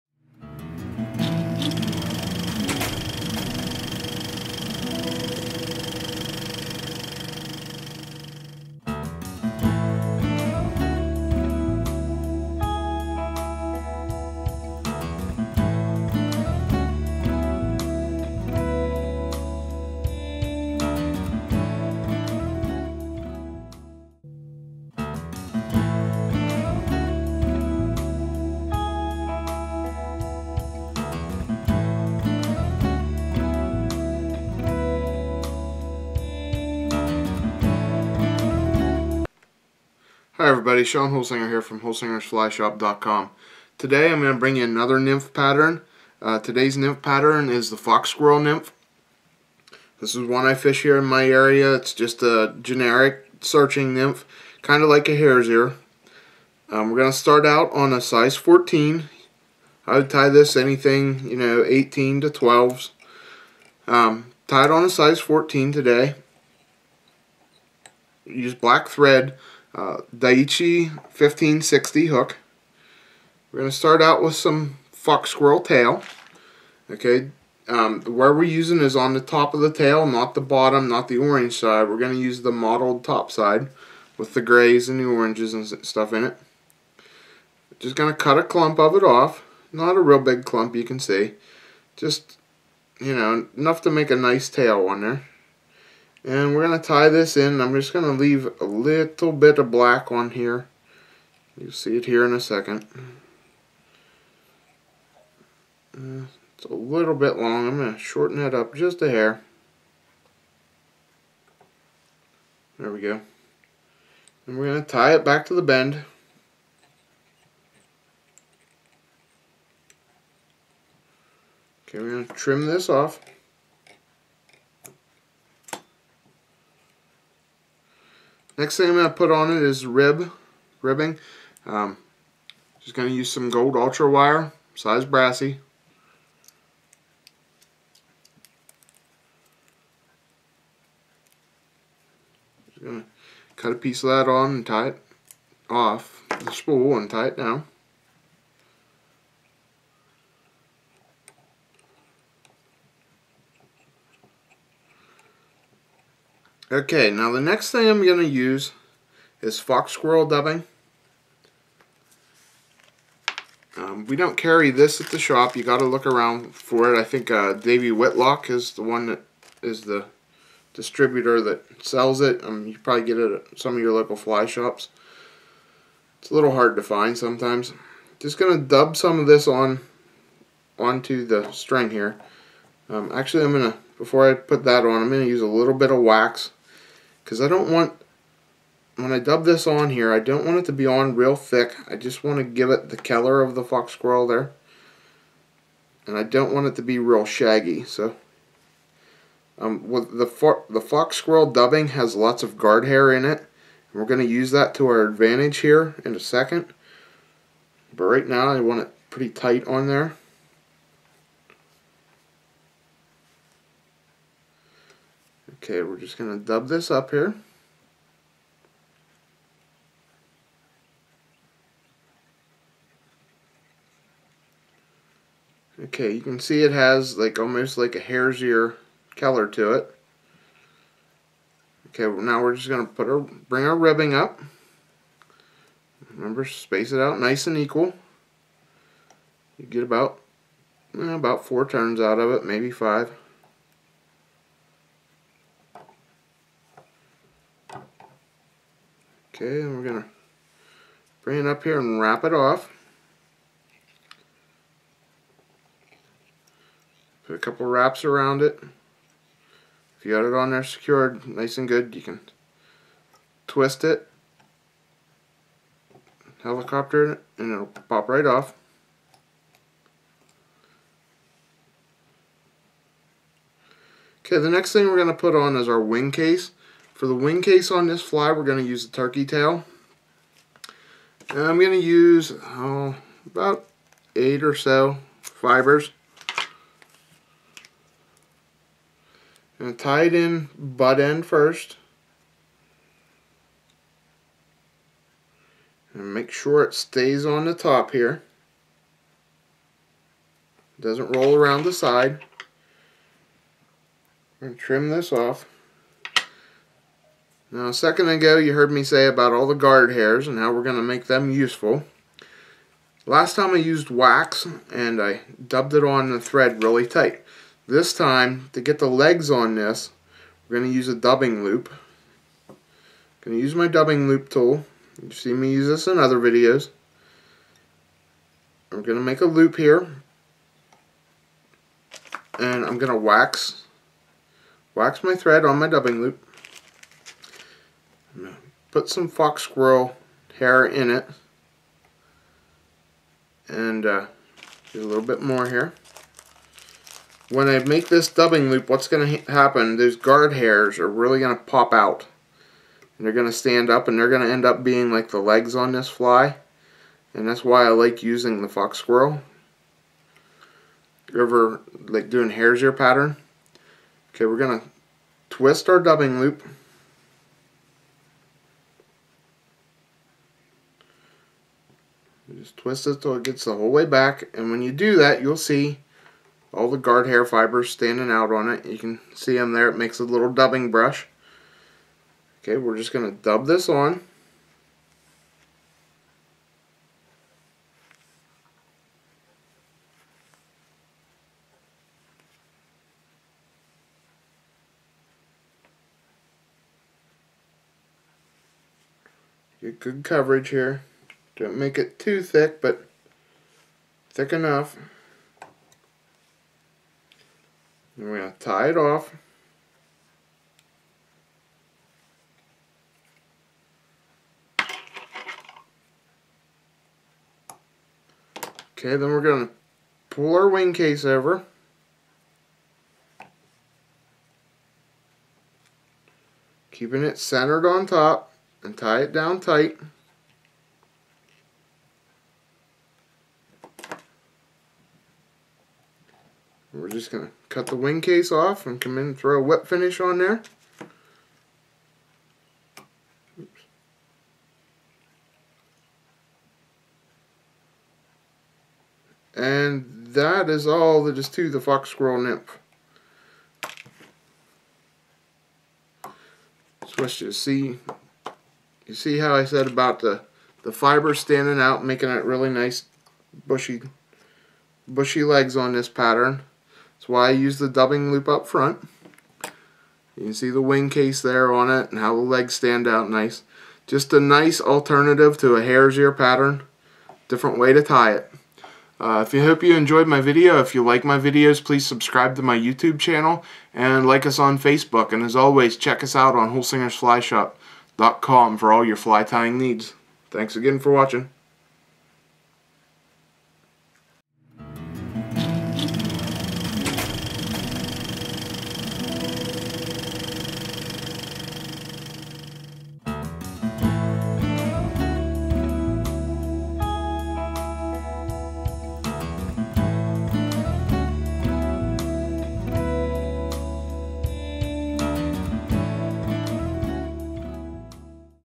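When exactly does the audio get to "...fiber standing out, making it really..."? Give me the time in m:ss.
7:40.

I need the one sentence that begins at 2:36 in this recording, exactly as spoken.
Okay, now the next thing I'm going to use is fox squirrel dubbing.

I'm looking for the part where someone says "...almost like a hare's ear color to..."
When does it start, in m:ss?
3:47.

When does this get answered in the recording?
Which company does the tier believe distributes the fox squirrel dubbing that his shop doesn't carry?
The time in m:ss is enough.
2:47.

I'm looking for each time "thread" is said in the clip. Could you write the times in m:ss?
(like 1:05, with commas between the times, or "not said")
1:08, 5:16, 5:35.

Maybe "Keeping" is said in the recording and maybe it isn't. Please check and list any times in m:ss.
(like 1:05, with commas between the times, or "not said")
7:06.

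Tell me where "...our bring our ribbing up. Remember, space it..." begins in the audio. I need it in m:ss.
3:53.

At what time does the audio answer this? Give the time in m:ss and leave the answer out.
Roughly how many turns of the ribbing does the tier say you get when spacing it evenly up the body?
4:01.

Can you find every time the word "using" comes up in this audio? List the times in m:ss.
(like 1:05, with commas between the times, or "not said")
1:18, 5:58.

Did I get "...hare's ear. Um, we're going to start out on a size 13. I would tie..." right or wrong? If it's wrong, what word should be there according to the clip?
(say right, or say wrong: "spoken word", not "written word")
wrong: "14", not "13".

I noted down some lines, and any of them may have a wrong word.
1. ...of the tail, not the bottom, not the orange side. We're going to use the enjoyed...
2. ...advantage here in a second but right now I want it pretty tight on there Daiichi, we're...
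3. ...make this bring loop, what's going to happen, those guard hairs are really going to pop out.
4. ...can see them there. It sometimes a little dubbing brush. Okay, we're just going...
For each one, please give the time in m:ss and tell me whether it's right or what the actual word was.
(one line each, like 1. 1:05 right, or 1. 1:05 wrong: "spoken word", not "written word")
1. 1:19 wrong: "mottled", not "enjoyed"
2. 3:25 wrong: "Okay", not "Daiichi"
3. 5:47 wrong: "dubbing", not "bring"
4. 6:18 wrong: "makes", not "sometimes".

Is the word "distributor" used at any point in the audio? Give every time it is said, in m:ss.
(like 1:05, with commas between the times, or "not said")
2:50.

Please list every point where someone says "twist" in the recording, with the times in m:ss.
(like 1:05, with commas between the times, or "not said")
4:23, 6:05, 6:12.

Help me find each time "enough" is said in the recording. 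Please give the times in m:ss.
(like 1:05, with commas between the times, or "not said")
1:33, 6:44.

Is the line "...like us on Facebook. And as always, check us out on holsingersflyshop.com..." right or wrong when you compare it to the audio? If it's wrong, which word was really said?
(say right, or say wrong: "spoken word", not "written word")
right.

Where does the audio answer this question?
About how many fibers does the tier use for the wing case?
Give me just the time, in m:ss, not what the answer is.
4:43.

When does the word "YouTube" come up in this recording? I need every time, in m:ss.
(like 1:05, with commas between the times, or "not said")
8:02.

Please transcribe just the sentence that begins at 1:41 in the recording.
You'll see it here in a second.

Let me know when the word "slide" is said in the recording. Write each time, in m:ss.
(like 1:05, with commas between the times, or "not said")
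not said.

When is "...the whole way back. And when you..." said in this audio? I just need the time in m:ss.
6:13.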